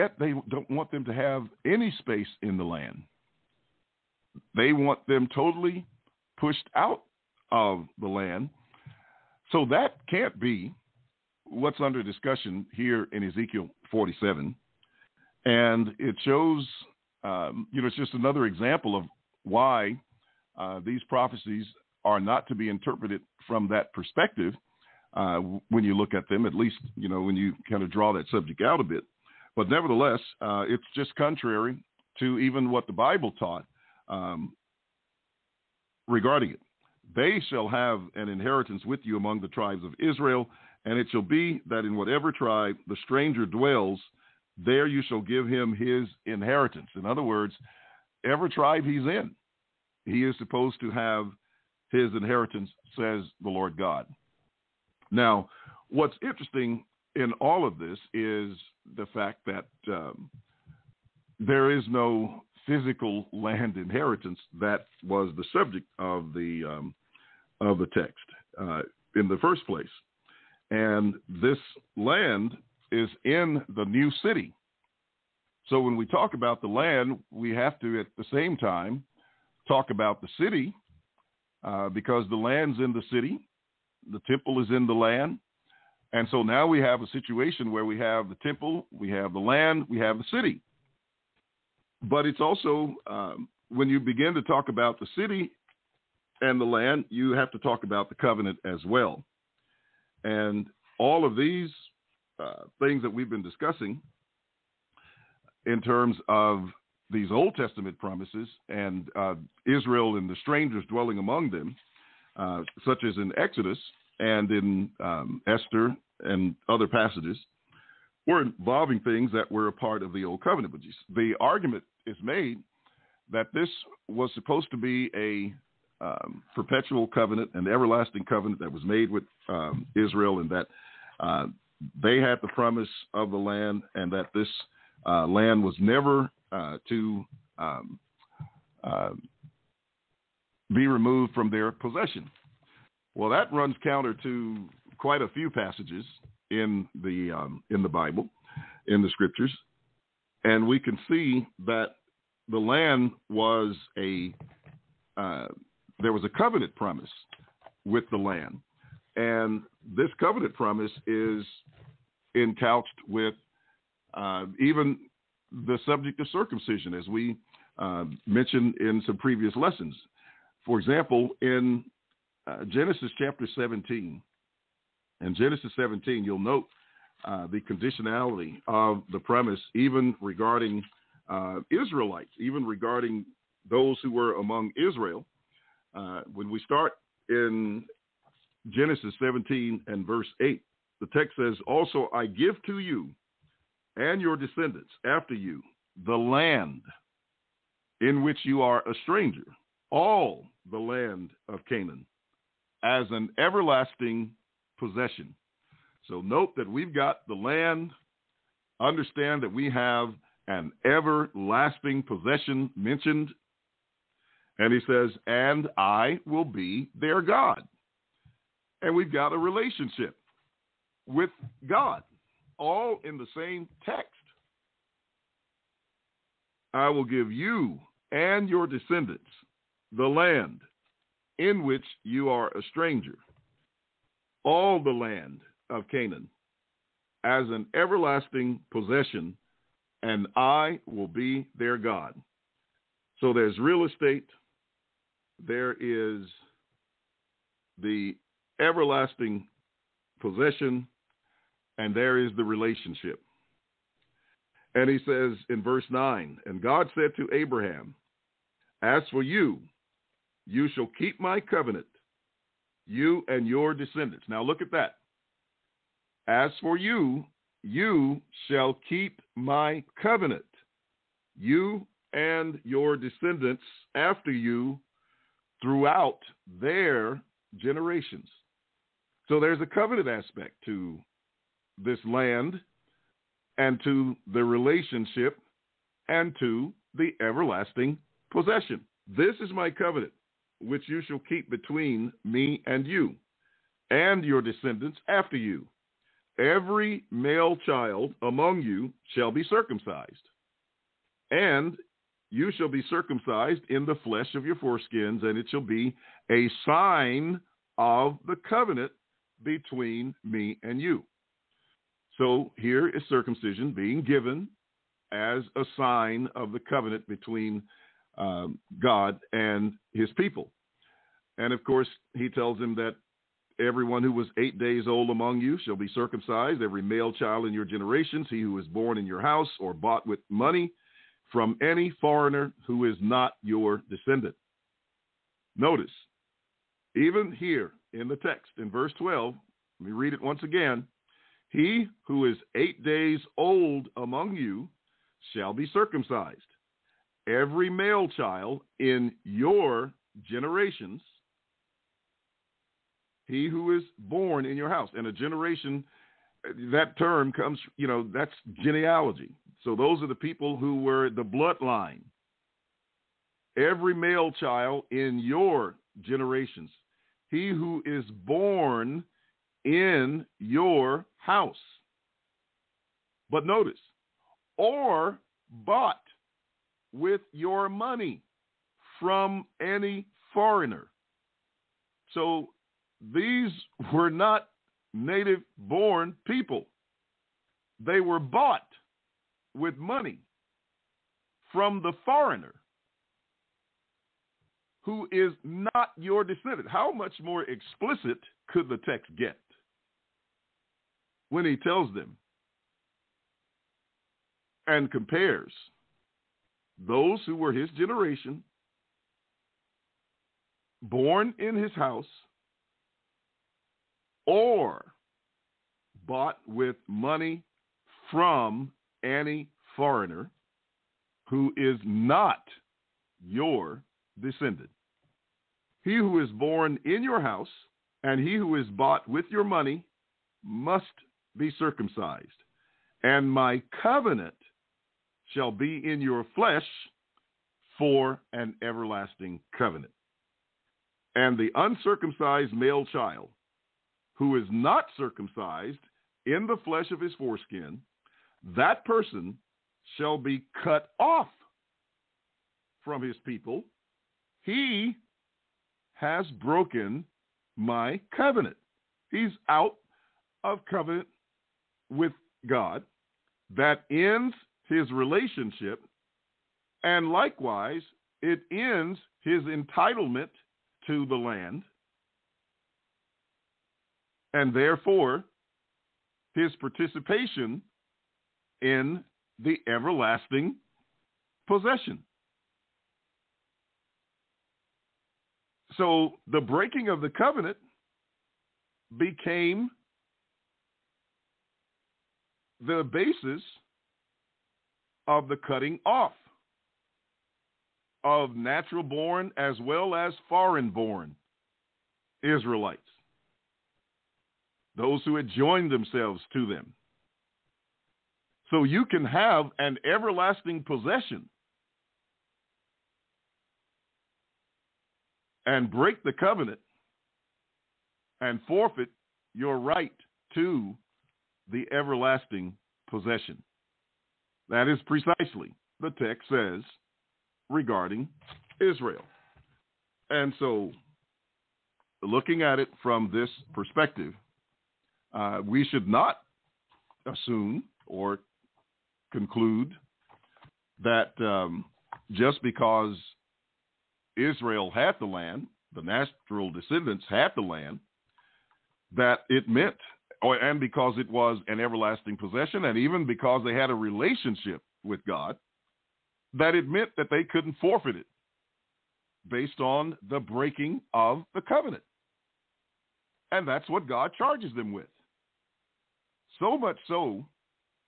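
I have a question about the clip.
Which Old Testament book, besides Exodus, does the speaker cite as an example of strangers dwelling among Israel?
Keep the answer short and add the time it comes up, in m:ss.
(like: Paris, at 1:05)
Esther, at 1:55.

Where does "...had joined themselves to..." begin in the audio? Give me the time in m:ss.
8:25.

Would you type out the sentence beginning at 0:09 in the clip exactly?
So that can't be what's under discussion here in Ezekiel 47.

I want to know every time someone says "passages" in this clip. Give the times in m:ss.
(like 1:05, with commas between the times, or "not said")
1:56, 2:25.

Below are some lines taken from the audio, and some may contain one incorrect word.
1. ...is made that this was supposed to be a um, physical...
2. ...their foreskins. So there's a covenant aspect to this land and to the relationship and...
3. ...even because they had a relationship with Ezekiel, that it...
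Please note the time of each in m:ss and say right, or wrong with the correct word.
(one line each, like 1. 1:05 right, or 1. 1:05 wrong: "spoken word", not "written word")
1. 2:02 wrong: "perpetual", not "physical"
2. 4:36 wrong: "generations", not "foreskins"
3. 9:12 wrong: "God", not "Ezekiel".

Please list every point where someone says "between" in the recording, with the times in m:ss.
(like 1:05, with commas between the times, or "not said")
4:51, 5:09, 5:17.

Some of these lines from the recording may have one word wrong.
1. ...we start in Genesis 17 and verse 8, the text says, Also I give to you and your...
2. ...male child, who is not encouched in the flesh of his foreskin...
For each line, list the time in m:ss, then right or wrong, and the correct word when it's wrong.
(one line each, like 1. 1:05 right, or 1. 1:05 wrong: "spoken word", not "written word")
1. 3:06 right
2. 7:22 wrong: "circumcised", not "encouched".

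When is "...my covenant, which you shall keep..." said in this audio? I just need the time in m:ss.
4:49.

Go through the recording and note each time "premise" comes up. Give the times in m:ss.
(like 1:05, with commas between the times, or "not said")
2:59.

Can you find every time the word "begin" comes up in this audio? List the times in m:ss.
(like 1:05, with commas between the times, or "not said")
1:34.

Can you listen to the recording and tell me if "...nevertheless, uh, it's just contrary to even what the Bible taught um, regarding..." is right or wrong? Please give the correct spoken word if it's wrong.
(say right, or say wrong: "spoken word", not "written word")
right.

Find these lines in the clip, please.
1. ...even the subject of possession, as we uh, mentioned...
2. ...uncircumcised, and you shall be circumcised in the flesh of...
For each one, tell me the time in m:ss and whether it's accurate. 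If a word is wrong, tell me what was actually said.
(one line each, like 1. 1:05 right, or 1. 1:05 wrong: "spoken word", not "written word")
1. 2:44 wrong: "circumcision", not "possession"
2. 4:59 wrong: "circumcised", not "uncircumcised".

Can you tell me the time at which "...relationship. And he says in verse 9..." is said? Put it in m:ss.
4:12.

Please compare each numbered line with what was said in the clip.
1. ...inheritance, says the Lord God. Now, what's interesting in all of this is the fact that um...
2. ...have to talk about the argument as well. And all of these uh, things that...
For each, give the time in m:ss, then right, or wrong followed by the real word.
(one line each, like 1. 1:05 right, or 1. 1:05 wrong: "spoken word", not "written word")
1. 0:52 right
2. 1:37 wrong: "covenant", not "argument".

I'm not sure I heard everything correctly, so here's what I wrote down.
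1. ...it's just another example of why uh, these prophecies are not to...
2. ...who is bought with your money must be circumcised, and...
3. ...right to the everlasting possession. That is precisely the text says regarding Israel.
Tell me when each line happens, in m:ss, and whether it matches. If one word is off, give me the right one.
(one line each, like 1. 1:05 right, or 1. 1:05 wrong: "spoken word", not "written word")
1. 0:17 right
2. 7:08 right
3. 8:39 right.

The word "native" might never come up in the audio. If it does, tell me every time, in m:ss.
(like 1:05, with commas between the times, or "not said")
6:24.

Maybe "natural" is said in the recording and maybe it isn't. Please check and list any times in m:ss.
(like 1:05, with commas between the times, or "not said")
8:18, 9:05.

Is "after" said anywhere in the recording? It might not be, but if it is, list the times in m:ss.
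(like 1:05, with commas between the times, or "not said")
3:15, 4:33, 4:55.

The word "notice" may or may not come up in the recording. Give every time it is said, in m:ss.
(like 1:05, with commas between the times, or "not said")
5:35, 6:13.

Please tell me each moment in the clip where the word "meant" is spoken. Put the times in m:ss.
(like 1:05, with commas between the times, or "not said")
9:09, 9:16.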